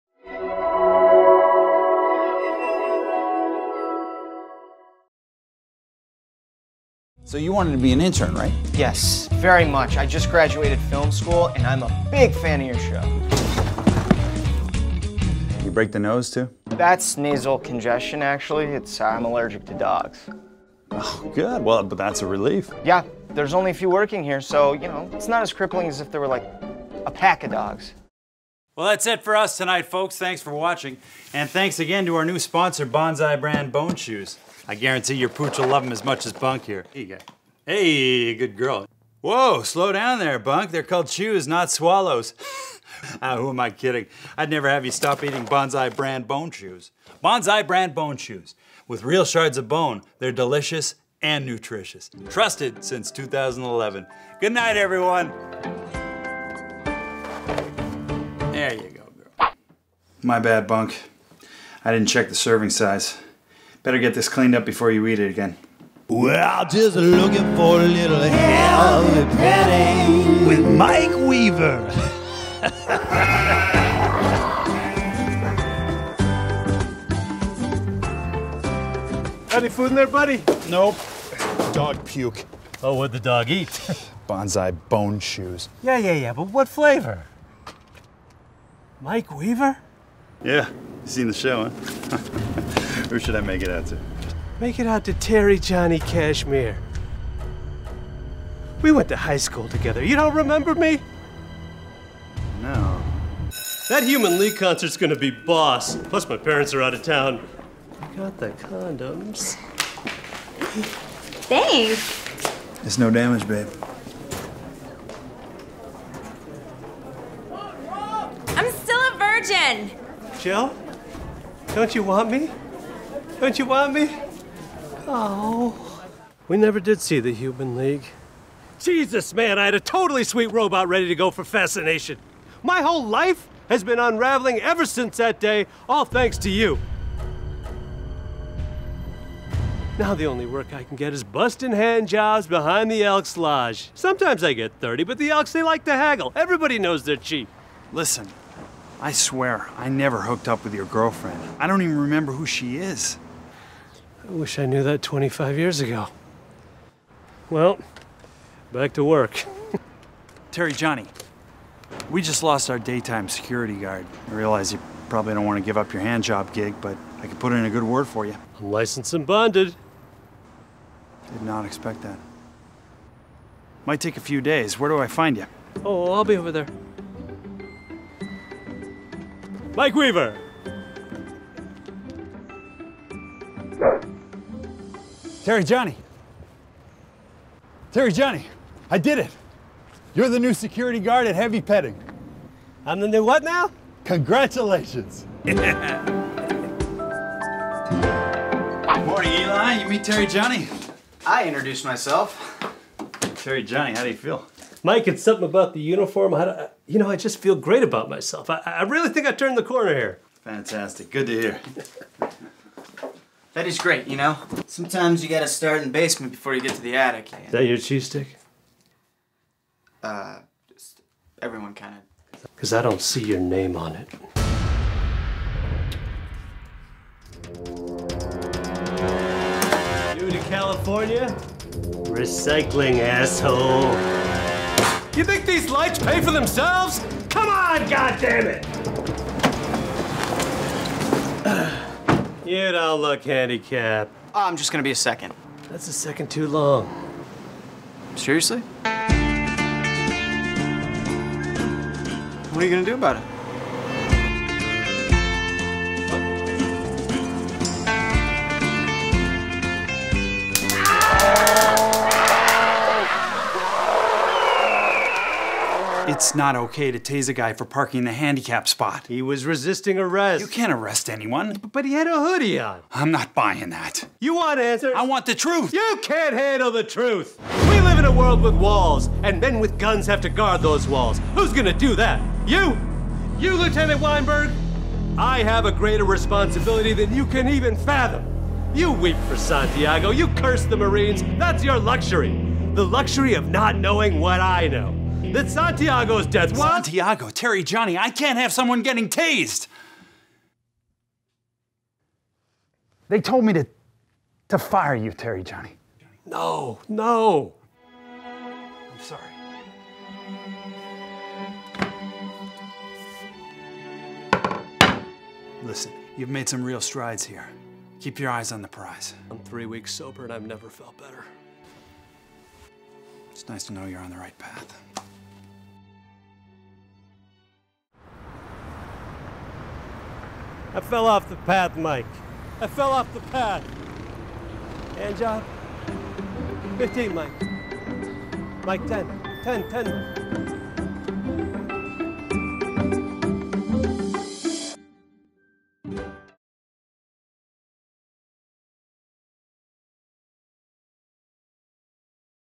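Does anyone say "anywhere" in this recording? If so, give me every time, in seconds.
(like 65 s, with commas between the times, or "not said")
not said.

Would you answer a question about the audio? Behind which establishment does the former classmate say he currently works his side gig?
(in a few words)
Elks Lodge.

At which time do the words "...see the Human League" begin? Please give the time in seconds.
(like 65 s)
127 s.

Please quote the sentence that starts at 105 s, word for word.
Plus, my parents are out of town.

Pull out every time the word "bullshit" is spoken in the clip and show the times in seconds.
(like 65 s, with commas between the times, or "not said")
not said.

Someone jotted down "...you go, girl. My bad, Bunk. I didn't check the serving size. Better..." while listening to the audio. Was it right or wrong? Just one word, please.
right.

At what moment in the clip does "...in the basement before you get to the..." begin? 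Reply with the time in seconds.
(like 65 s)
215 s.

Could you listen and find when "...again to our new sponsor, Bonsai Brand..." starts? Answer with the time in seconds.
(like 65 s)
31 s.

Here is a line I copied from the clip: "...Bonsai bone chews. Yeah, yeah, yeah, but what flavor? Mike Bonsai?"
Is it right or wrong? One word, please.
wrong.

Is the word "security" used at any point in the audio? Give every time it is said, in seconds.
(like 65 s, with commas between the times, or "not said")
163 s, 190 s.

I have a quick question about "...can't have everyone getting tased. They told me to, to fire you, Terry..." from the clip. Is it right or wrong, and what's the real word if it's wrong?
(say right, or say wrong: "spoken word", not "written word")
wrong: "someone", not "everyone".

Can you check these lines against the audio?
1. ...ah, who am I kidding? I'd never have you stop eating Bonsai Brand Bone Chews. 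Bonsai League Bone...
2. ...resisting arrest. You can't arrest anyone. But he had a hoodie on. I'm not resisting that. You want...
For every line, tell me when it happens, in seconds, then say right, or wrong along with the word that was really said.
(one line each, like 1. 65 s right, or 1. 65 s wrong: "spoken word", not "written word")
1. 43 s wrong: "Brand", not "League"
2. 269 s wrong: "buying", not "resisting".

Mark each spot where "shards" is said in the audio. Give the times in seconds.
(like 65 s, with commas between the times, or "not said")
49 s.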